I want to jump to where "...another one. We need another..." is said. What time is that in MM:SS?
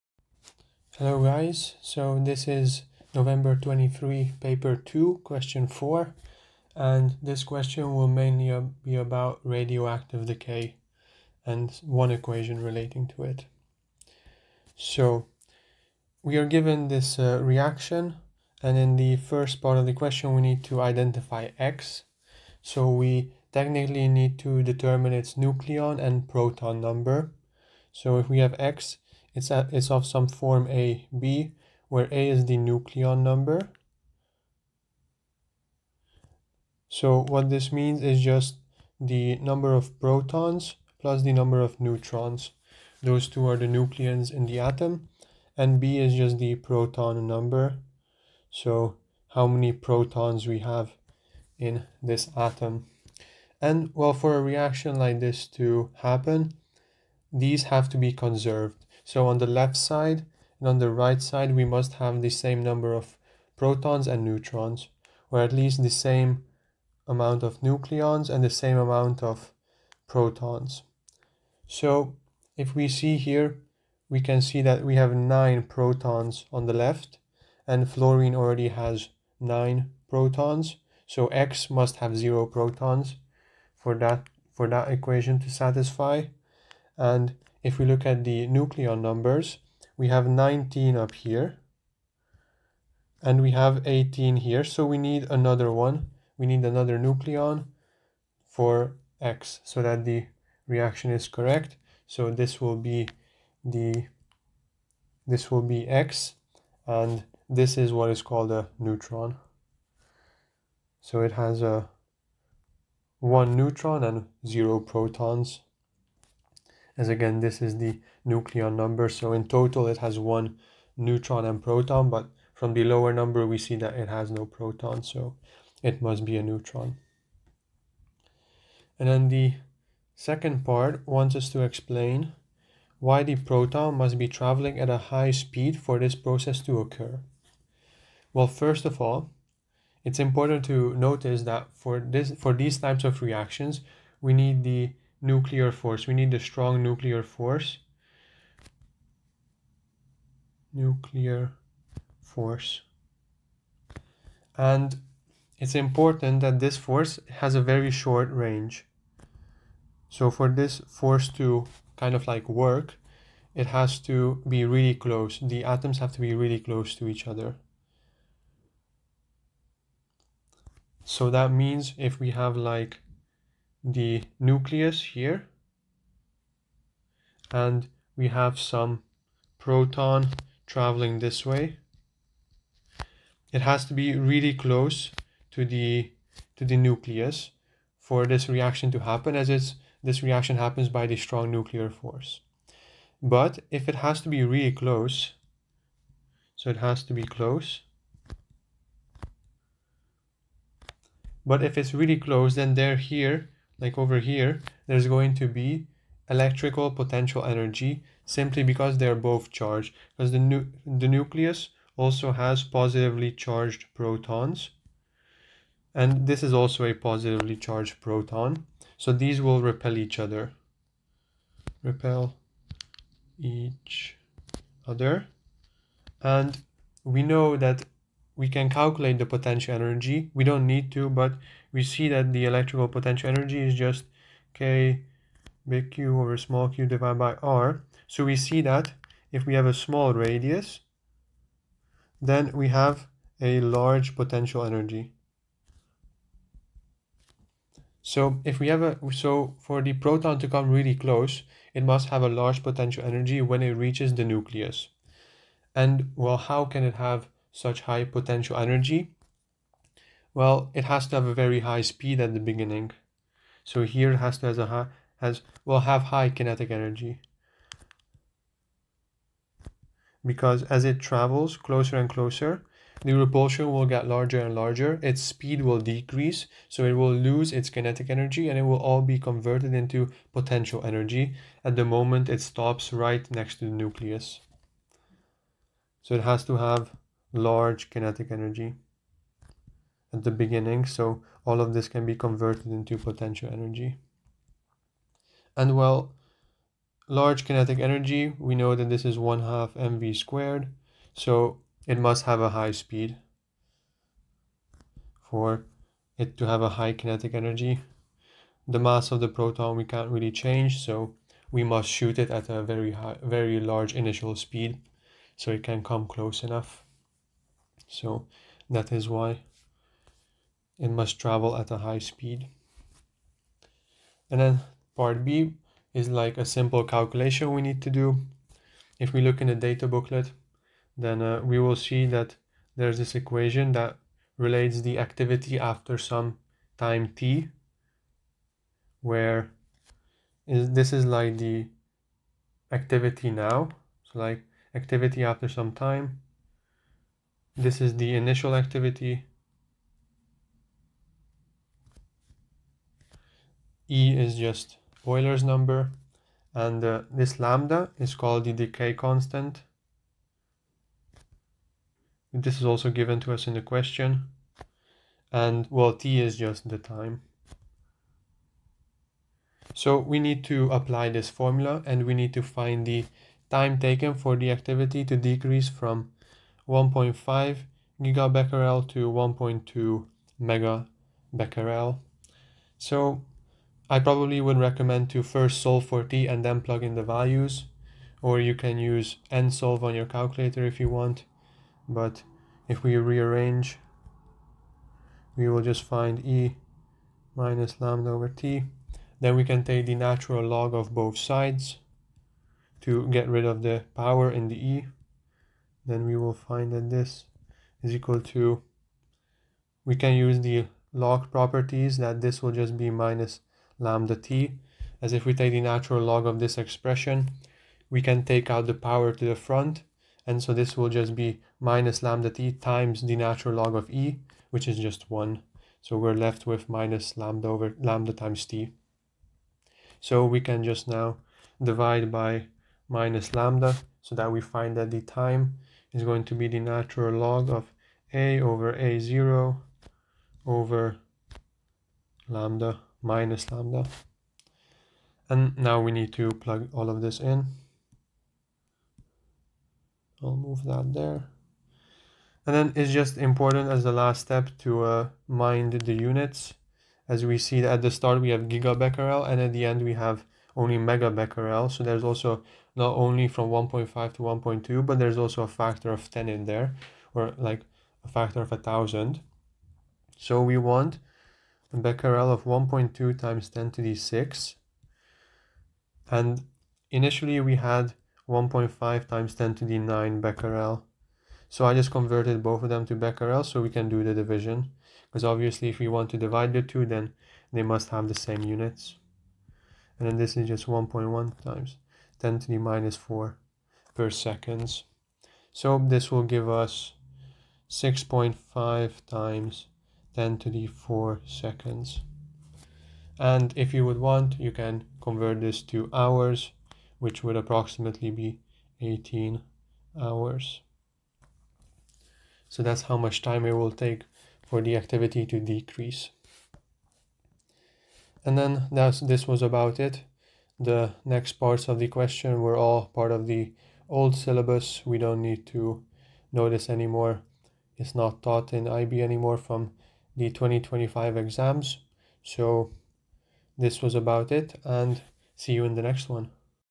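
01:35.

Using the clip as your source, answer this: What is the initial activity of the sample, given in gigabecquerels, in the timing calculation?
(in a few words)
1.5 GBq.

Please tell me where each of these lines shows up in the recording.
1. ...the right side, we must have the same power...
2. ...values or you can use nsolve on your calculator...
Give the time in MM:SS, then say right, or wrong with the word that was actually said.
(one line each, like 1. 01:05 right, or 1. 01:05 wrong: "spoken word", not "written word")
1. 01:00 wrong: "number", not "power"
2. 06:27 right.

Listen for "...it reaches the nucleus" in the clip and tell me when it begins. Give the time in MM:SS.
04:13.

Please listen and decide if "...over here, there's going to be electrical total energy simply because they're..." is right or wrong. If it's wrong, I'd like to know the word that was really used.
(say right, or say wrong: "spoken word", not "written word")
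wrong: "potential", not "total".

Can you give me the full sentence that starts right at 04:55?
And well, large kinetic energy, we know that this is 1 half mv squared.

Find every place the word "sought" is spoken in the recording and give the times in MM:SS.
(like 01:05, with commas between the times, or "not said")
not said.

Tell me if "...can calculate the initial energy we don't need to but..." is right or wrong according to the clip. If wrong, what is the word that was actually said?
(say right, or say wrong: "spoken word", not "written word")
wrong: "potential", not "initial".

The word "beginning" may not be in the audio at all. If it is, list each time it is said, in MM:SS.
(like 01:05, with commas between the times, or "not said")
04:22, 04:50.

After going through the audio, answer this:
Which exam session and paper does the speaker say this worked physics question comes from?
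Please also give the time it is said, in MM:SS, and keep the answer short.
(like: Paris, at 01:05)
November 23, paper 2, at 00:03.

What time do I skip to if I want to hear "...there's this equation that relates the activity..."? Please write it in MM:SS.
05:32.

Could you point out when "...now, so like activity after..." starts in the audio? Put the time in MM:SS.
05:43.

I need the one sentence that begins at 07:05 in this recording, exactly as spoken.
So we're left with minus lambda over lambda times t.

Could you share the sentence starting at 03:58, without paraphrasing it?
So we see that if we have a small radius, then we have a large potential energy.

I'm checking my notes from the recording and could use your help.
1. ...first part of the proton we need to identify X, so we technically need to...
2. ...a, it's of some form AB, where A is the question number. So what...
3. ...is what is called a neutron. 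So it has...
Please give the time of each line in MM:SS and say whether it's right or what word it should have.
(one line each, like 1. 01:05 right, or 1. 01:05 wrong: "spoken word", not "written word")
1. 00:19 wrong: "question", not "proton"
2. 00:29 wrong: "nucleon", not "question"
3. 01:47 right.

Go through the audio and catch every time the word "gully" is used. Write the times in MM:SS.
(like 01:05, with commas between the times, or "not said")
not said.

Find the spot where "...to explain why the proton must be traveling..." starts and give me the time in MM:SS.
02:11.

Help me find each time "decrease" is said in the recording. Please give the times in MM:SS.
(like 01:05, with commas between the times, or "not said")
04:35, 06:15, 08:35.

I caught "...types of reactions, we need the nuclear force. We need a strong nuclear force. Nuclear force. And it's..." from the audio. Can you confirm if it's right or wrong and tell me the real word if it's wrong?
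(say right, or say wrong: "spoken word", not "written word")
right.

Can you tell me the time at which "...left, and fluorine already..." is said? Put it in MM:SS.
01:16.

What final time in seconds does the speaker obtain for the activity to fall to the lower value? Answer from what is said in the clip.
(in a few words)
6.5 × 10^4 seconds.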